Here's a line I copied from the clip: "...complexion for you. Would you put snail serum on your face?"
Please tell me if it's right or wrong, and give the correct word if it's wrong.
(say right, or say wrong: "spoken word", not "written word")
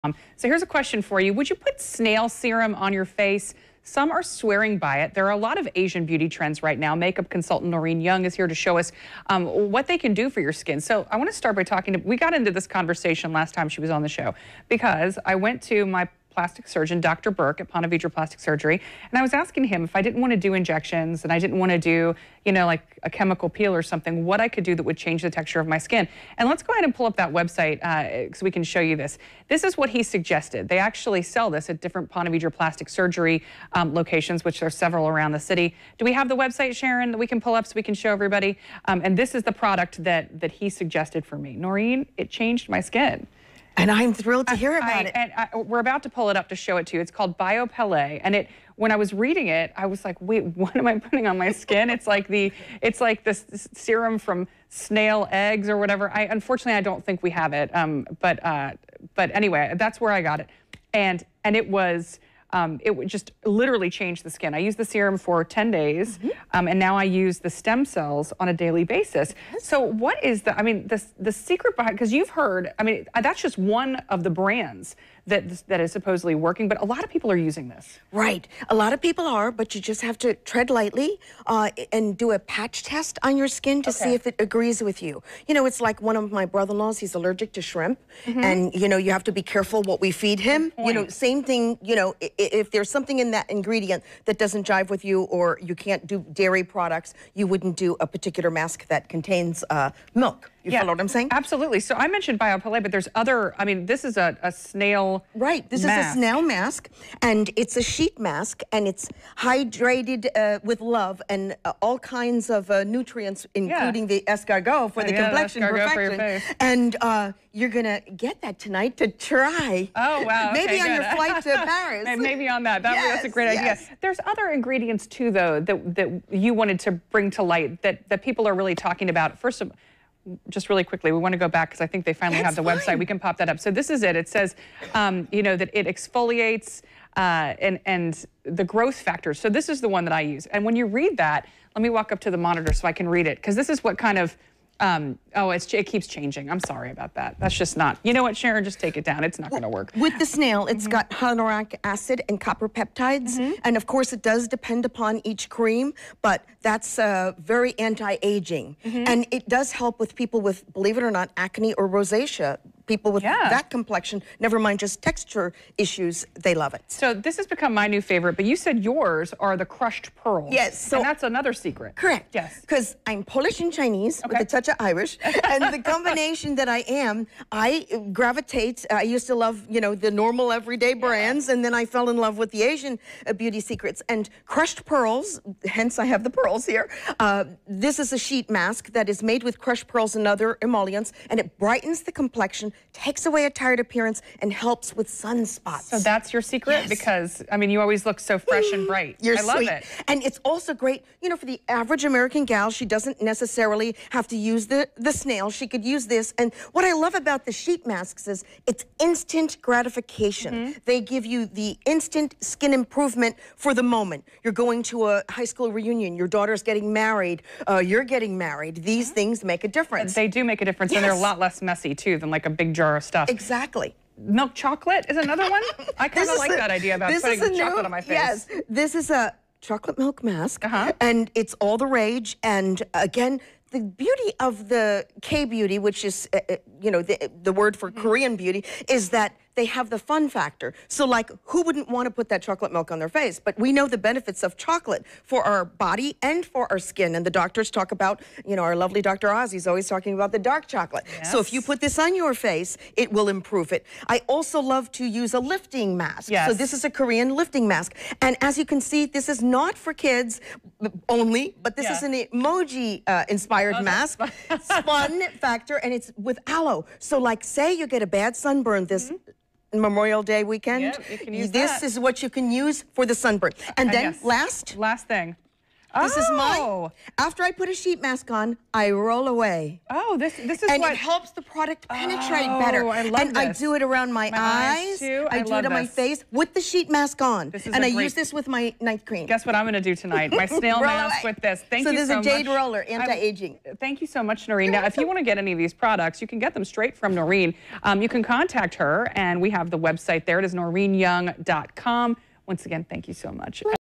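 wrong: "question", not "complexion".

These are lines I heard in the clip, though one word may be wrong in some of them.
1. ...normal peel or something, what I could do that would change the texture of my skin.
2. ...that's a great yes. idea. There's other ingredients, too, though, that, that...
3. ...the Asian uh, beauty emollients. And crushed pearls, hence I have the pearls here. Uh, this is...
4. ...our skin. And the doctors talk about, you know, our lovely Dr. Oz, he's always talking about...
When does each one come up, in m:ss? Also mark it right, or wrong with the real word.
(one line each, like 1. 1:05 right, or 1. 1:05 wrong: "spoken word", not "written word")
1. 0:23 wrong: "chemical", not "normal"
2. 2:03 right
3. 3:02 wrong: "secrets", not "emollients"
4. 4:06 right.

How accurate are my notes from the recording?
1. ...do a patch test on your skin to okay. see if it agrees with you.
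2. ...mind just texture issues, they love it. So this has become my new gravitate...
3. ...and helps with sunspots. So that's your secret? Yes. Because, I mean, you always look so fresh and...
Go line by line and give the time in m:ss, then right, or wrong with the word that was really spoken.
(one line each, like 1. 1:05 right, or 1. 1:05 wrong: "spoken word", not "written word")
1. 1:22 right
2. 2:44 wrong: "favorite", not "gravitate"
3. 3:14 right.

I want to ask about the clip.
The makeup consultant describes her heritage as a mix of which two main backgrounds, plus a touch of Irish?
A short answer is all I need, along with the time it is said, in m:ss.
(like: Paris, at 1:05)
Polish and Chinese, at 2:53.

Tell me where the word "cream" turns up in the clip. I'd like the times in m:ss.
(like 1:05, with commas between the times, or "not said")
2:35, 4:49.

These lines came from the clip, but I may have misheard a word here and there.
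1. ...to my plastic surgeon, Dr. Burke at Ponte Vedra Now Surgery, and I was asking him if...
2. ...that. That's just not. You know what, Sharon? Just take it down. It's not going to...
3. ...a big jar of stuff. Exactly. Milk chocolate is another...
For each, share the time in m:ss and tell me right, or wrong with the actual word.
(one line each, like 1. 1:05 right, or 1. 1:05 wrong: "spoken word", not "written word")
1. 0:15 wrong: "Plastic", not "Now"
2. 2:27 right
3. 3:42 right.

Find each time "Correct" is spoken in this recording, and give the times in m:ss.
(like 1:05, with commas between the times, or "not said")
2:51.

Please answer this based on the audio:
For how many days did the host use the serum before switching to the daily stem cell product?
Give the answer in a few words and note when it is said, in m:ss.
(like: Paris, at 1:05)
10, at 1:05.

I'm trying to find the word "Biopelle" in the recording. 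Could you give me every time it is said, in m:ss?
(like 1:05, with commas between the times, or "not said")
0:47, 1:42.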